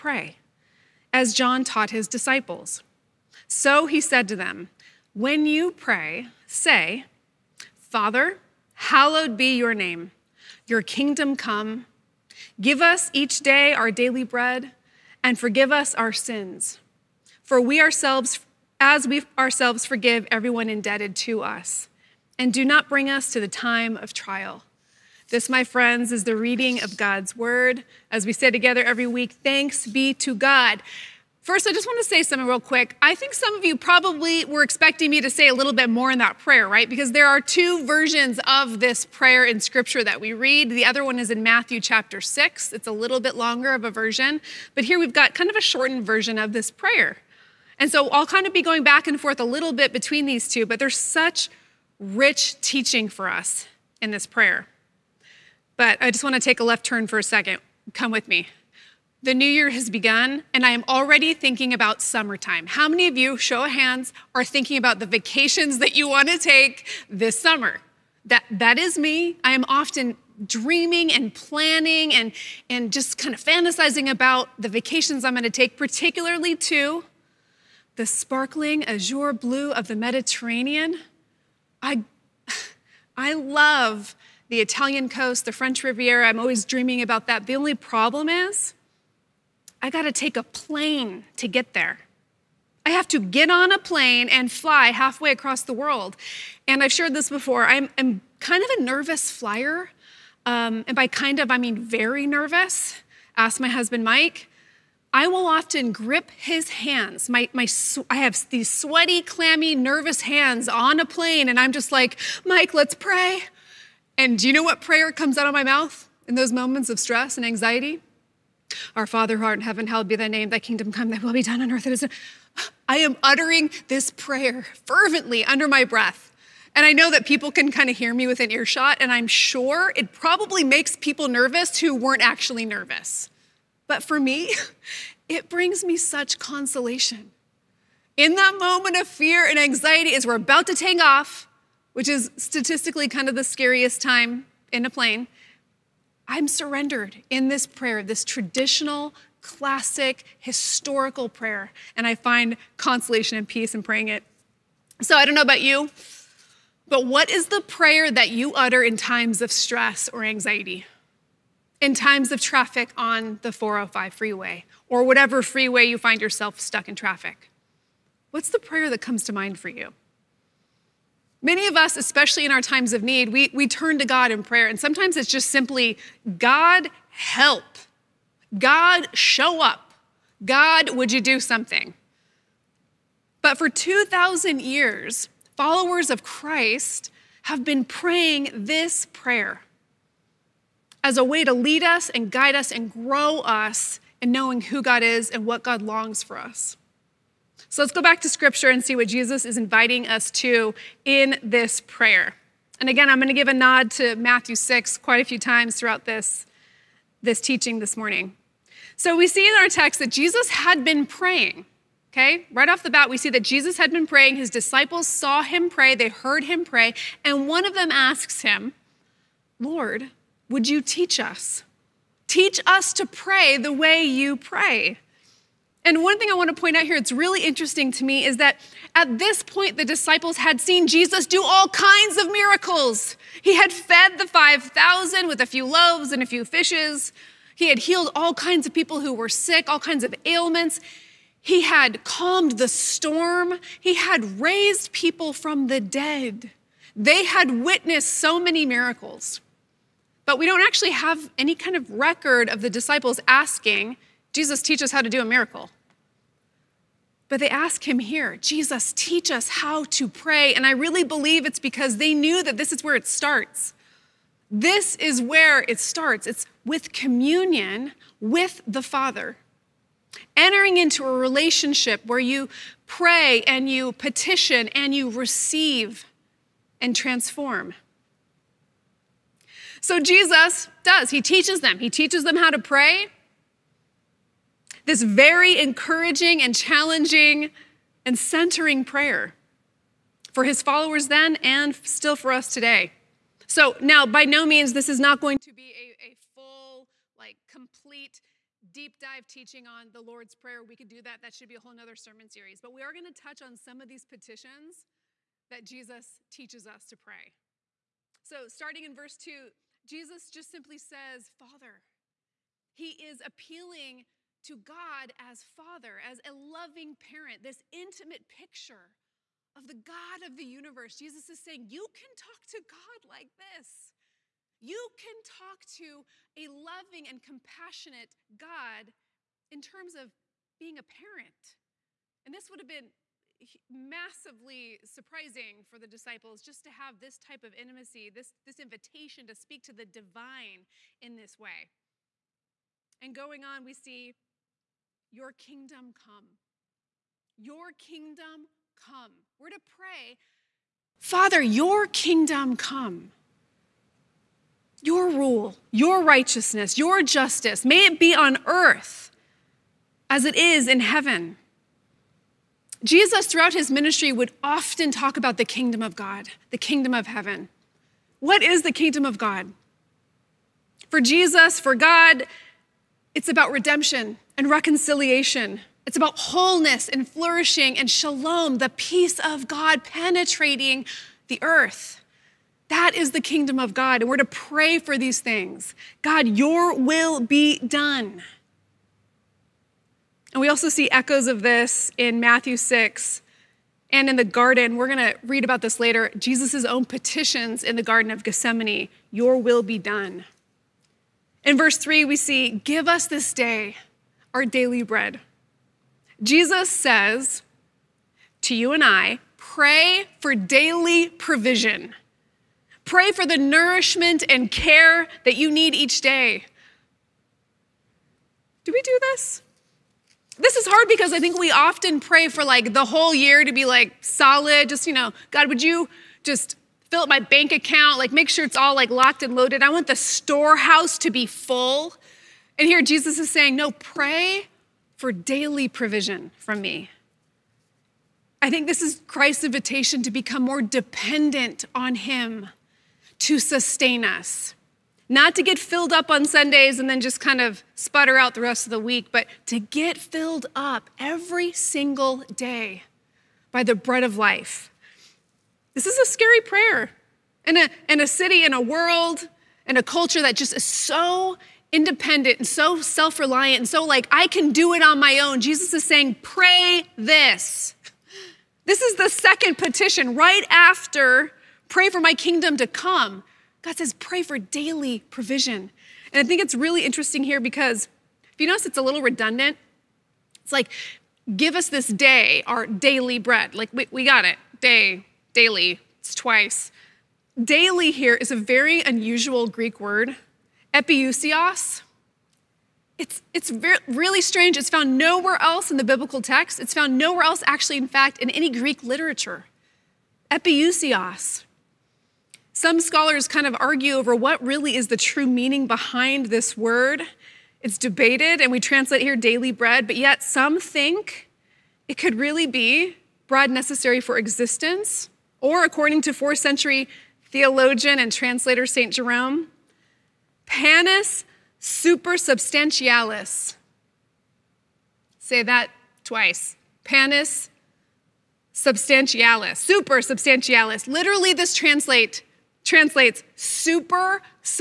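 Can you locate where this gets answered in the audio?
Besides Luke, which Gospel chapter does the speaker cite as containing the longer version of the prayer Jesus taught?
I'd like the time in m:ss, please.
0:41.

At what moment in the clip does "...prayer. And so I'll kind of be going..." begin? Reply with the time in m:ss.
0:46.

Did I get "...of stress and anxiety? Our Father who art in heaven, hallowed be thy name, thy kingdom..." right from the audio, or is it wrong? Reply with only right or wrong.
right.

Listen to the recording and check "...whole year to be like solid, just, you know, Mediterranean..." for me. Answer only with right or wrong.
wrong.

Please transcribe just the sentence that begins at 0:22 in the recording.
And do not bring us to the time of trial.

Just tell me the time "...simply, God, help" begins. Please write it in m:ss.
2:55.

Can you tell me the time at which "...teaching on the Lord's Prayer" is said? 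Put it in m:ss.
4:59.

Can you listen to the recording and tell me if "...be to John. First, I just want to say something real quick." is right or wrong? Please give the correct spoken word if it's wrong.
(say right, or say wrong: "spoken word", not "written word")
wrong: "God", not "John".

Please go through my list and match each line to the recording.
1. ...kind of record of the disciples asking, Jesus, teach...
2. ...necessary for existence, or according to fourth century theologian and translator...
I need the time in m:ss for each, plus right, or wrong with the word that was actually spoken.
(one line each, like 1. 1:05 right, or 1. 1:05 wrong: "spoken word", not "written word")
1. 4:11 right
2. 8:33 right.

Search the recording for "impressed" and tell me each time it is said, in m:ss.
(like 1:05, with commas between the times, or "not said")
not said.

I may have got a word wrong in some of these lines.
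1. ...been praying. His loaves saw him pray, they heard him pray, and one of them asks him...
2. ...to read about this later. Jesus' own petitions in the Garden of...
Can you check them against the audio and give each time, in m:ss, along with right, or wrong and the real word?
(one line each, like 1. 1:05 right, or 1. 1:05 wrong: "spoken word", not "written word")
1. 3:33 wrong: "disciples", not "loaves"
2. 6:35 right.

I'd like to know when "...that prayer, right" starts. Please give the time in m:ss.
0:36.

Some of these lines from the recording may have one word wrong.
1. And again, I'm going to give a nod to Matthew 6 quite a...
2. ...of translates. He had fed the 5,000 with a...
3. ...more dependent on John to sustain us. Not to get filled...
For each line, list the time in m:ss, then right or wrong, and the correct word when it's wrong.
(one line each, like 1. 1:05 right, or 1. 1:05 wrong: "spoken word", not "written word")
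1. 3:22 right
2. 3:52 wrong: "miracles", not "translates"
3. 7:20 wrong: "Him", not "John".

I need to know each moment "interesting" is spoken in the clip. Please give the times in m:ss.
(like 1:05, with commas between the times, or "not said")
3:47, 7:56.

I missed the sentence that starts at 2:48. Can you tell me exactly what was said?
What's the prayer that comes to mind for you?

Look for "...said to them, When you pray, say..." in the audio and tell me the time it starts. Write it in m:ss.
0:04.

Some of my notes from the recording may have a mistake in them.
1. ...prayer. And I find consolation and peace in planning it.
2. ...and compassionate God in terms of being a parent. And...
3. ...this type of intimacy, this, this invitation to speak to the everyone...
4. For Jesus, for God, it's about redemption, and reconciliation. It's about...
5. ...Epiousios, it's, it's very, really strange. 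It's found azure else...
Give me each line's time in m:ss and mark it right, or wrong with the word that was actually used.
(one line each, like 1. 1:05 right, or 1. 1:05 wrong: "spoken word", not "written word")
1. 2:31 wrong: "praying", not "planning"
2. 5:27 right
3. 5:36 wrong: "divine", not "everyone"
4. 6:10 right
5. 8:10 wrong: "nowhere", not "azure".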